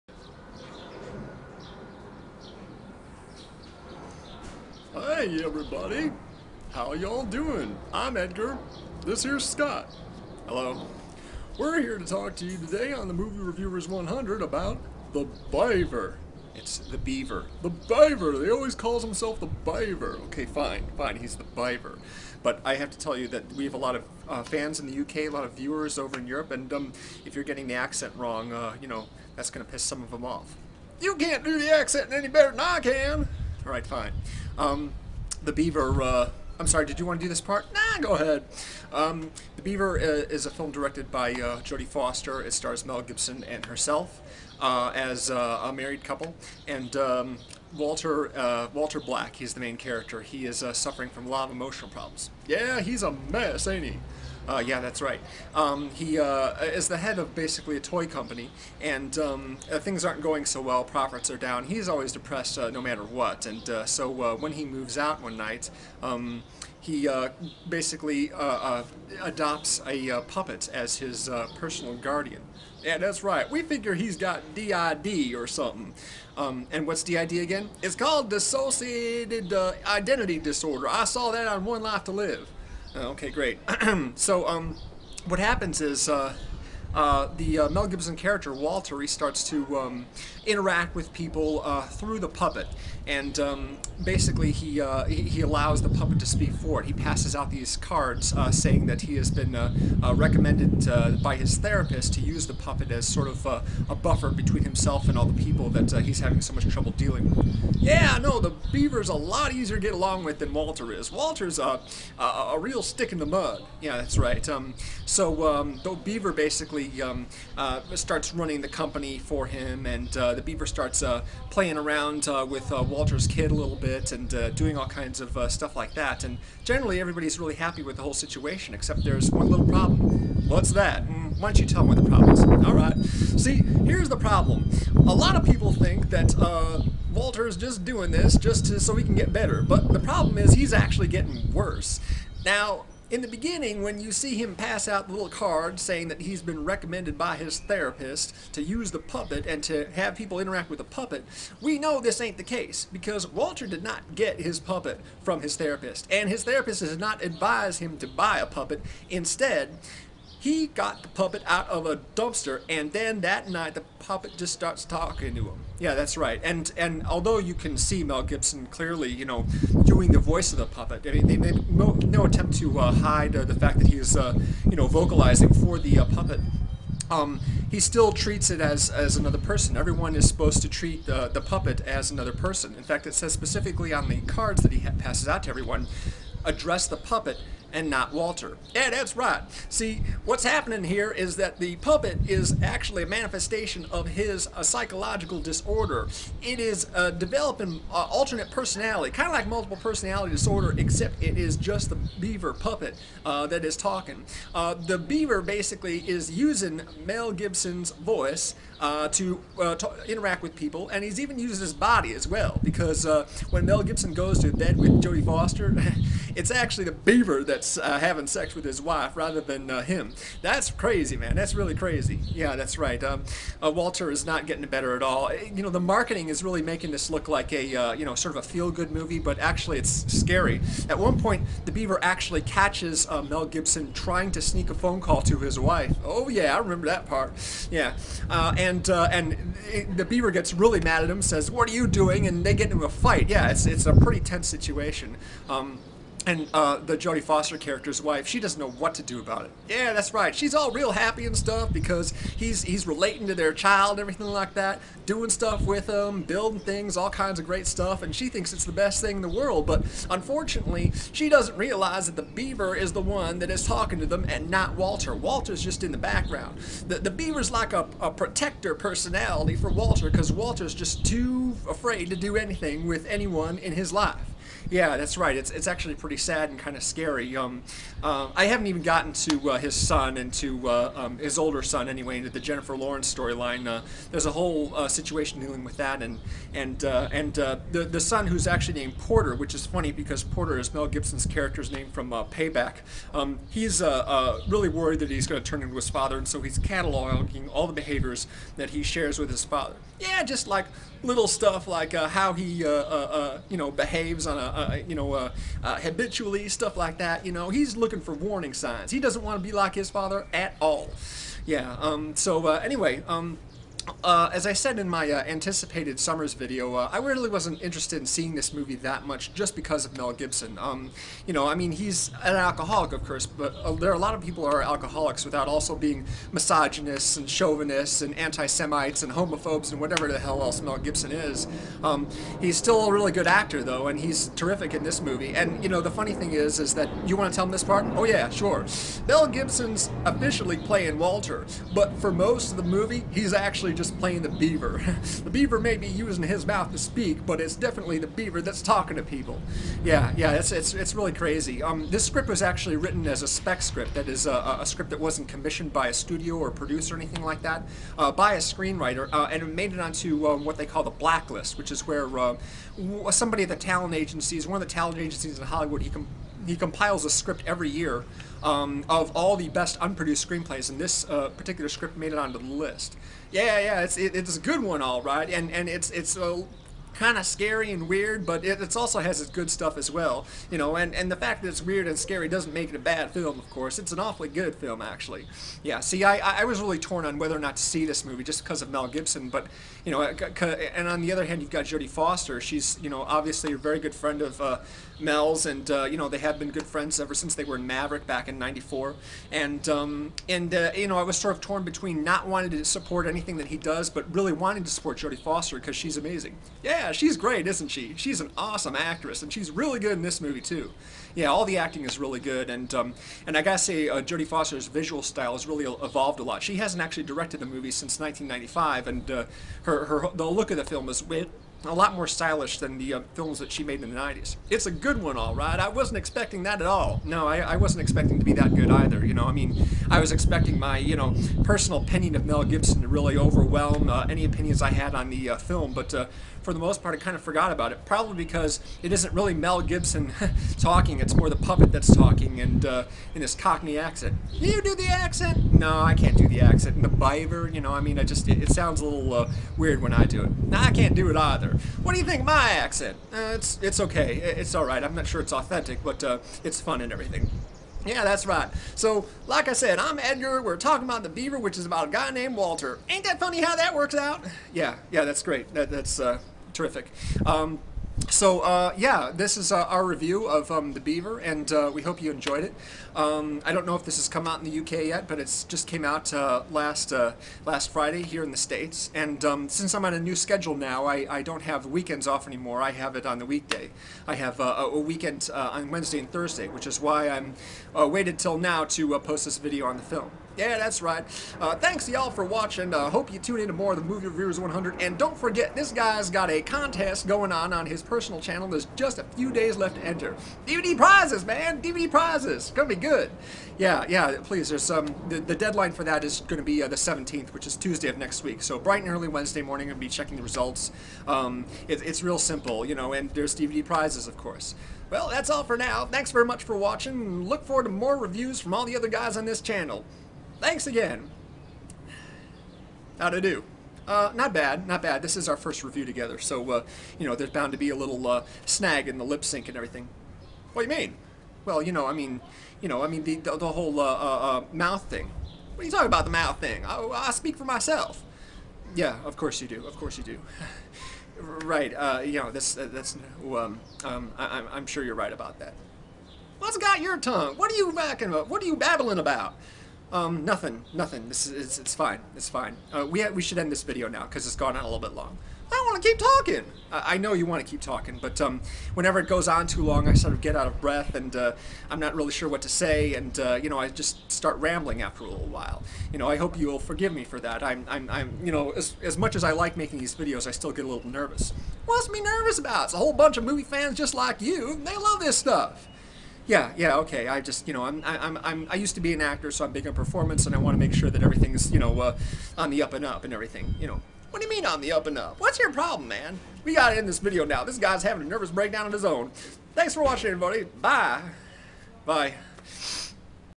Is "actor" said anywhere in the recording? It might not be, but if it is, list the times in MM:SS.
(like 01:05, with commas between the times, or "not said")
05:33, 09:39.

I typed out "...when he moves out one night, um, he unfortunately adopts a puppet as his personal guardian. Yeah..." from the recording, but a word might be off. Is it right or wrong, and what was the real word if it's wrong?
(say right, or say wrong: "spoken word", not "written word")
wrong: "basically", not "unfortunately".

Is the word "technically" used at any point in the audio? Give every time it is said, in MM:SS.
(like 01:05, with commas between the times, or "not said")
not said.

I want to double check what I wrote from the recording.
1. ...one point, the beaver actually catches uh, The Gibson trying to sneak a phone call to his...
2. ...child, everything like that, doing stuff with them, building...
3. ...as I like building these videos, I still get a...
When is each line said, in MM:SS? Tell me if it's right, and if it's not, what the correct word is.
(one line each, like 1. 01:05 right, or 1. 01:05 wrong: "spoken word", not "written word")
1. 03:50 wrong: "Mel", not "The"
2. 04:13 right
3. 09:29 wrong: "making", not "building".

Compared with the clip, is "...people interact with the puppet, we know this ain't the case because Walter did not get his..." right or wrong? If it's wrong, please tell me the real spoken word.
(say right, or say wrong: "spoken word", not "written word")
right.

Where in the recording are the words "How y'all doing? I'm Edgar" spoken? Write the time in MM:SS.
00:06.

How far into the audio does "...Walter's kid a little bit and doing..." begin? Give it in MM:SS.
02:02.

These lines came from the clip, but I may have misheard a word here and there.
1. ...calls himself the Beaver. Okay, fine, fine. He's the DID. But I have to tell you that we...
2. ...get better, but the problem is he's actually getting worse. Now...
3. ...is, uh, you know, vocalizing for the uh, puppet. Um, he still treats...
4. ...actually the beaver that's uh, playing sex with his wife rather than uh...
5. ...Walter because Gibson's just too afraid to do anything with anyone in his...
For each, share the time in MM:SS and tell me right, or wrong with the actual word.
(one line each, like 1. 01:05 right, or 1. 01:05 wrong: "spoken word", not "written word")
1. 00:18 wrong: "Beaver", not "DID"
2. 02:19 right
3. 02:53 right
4. 03:36 wrong: "having", not "playing"
5. 04:29 wrong: "Walter", not "Gibson".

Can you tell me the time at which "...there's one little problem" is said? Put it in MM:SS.
02:09.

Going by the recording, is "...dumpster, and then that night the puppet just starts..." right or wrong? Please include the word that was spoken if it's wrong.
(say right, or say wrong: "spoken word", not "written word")
right.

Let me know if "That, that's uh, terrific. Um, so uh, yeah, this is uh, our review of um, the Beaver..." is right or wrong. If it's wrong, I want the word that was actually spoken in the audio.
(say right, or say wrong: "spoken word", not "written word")
right.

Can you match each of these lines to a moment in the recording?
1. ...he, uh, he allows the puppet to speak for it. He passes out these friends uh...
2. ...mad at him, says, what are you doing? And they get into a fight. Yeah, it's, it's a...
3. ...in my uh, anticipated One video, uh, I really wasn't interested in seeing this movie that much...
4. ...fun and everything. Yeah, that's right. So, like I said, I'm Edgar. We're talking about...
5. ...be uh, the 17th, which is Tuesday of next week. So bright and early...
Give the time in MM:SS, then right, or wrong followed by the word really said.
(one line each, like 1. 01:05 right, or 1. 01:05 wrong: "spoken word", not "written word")
1. 01:34 wrong: "cards", not "friends"
2. 04:00 right
3. 05:14 wrong: "Summers", not "One"
4. 07:36 right
5. 08:26 right.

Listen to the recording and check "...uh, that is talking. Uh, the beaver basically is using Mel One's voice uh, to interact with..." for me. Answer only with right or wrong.
wrong.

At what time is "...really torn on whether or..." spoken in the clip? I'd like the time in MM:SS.
06:26.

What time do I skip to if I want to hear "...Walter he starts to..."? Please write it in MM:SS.
01:28.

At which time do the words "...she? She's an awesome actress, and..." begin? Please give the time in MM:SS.
06:47.